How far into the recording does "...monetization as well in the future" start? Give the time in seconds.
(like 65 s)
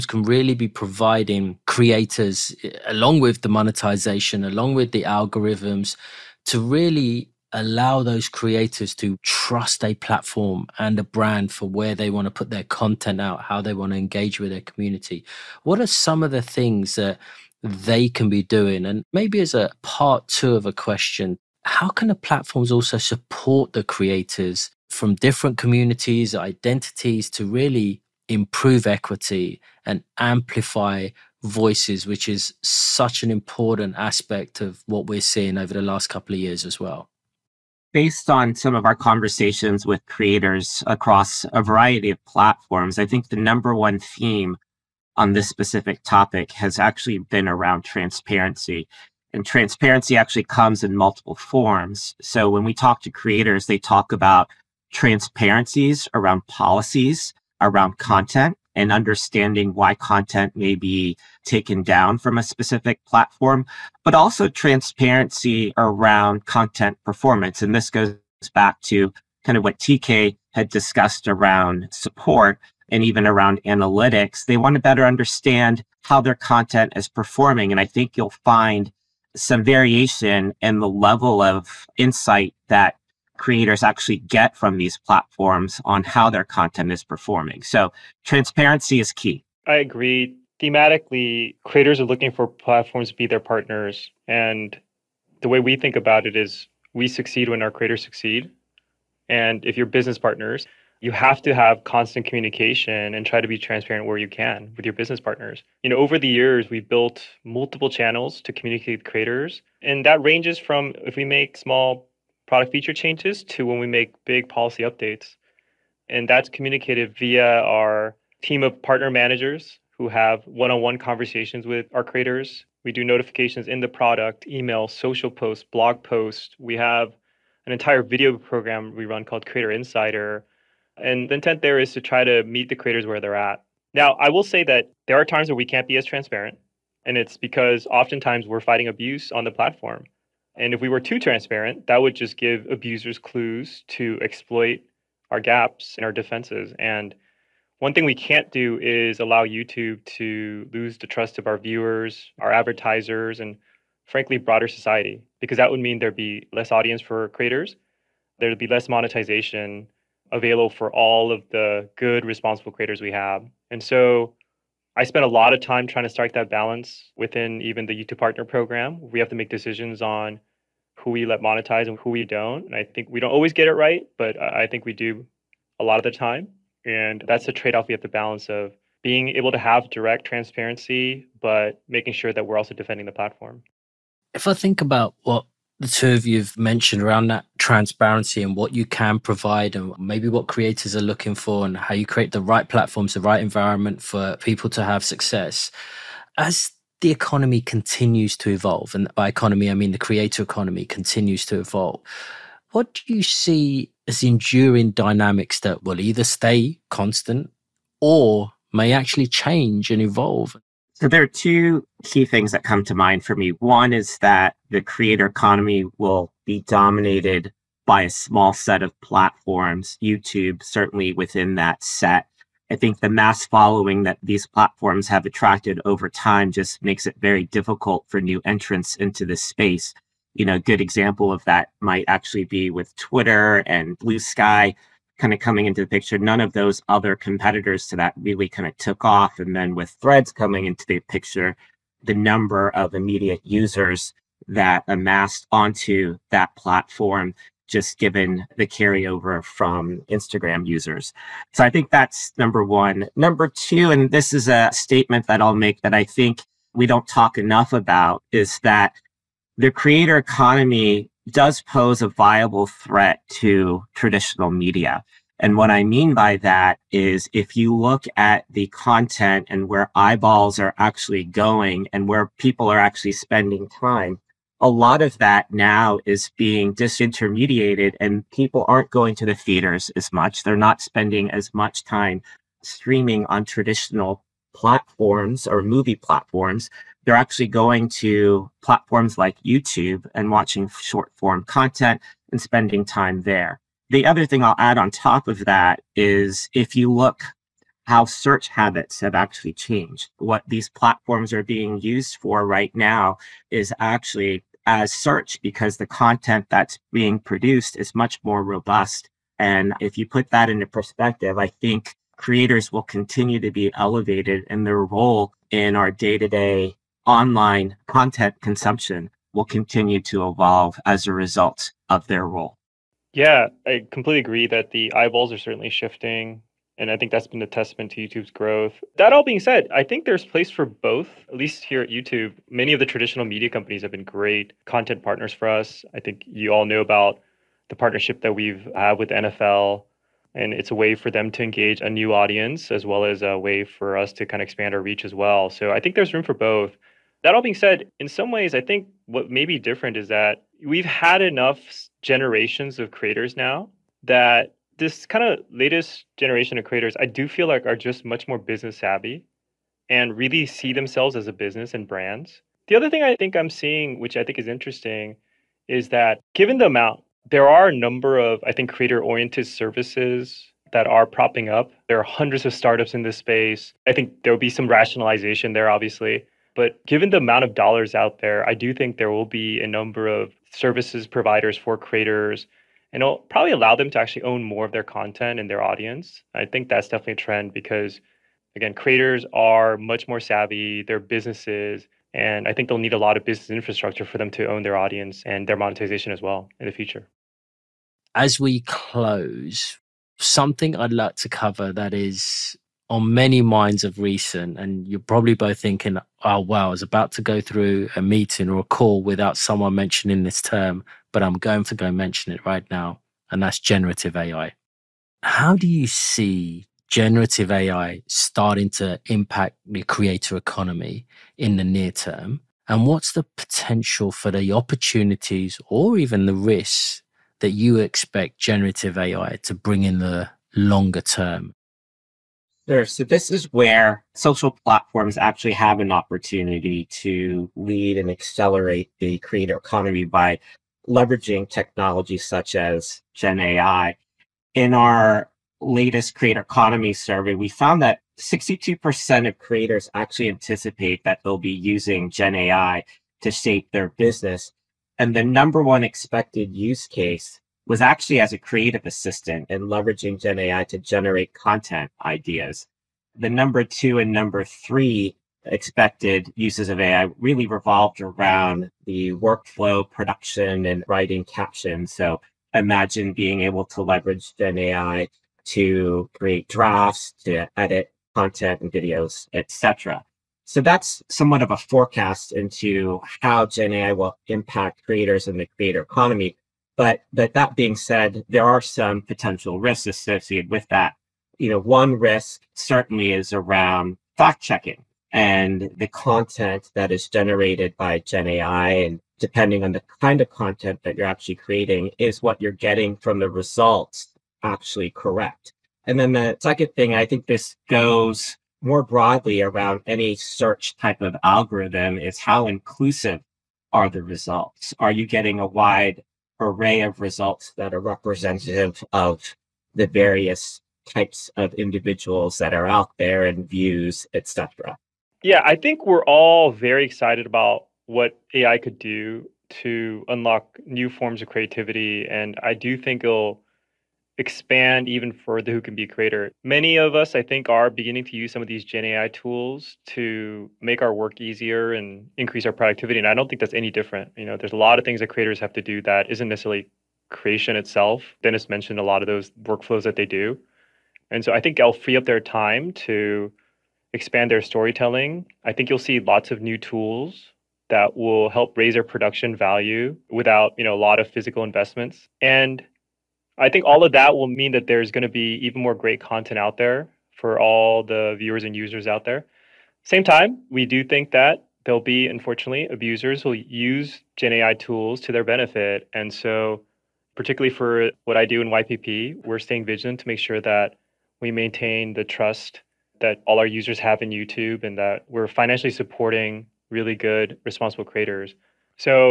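395 s.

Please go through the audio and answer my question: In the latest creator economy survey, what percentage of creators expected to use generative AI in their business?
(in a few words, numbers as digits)
62%.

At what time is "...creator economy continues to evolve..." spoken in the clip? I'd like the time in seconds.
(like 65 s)
199 s.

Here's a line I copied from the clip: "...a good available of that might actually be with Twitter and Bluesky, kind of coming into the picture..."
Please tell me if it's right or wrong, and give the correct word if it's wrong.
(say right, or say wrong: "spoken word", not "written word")
wrong: "example", not "available".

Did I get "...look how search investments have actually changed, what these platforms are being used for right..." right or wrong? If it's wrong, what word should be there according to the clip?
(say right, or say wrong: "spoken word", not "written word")
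wrong: "habits", not "investments".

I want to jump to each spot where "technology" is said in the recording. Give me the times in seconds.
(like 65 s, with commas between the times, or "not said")
441 s.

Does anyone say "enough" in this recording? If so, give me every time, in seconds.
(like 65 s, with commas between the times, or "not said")
257 s, 351 s.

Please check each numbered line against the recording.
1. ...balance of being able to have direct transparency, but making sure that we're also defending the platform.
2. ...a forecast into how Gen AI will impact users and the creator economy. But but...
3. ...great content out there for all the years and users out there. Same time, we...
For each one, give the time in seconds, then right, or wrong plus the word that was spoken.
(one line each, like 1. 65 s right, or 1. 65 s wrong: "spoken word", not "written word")
1. 178 s right
2. 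481 s wrong: "creators", not "users"
3. 565 s wrong: "viewers", not "years".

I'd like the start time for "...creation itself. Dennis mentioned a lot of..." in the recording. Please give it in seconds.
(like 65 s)
547 s.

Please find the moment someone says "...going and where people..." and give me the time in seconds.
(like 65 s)
271 s.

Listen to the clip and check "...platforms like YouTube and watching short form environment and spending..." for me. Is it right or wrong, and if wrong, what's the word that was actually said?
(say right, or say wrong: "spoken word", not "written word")
wrong: "content", not "environment".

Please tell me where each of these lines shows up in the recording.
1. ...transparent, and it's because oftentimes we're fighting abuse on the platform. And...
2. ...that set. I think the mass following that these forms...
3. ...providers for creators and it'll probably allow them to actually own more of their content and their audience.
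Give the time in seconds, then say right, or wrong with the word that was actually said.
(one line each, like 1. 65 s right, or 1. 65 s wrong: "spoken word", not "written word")
1. 136 s right
2. 221 s wrong: "platforms", not "forms"
3. 381 s right.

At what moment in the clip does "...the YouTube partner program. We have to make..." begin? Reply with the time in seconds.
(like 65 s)
167 s.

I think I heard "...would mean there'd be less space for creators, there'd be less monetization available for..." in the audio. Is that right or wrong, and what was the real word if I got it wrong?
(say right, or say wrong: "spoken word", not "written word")
wrong: "audience", not "space".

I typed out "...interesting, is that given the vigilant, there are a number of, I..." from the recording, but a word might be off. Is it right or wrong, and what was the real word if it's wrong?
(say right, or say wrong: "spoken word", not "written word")
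wrong: "amount", not "vigilant".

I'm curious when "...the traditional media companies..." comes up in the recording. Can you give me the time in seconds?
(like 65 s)
332 s.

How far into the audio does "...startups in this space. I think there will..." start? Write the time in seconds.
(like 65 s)
372 s.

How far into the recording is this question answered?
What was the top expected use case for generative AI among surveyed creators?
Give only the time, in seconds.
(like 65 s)
458 s.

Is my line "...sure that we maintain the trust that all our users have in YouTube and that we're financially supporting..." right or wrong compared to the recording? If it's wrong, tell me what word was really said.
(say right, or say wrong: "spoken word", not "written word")
right.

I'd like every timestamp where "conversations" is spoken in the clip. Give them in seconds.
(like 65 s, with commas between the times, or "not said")
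38 s, 120 s.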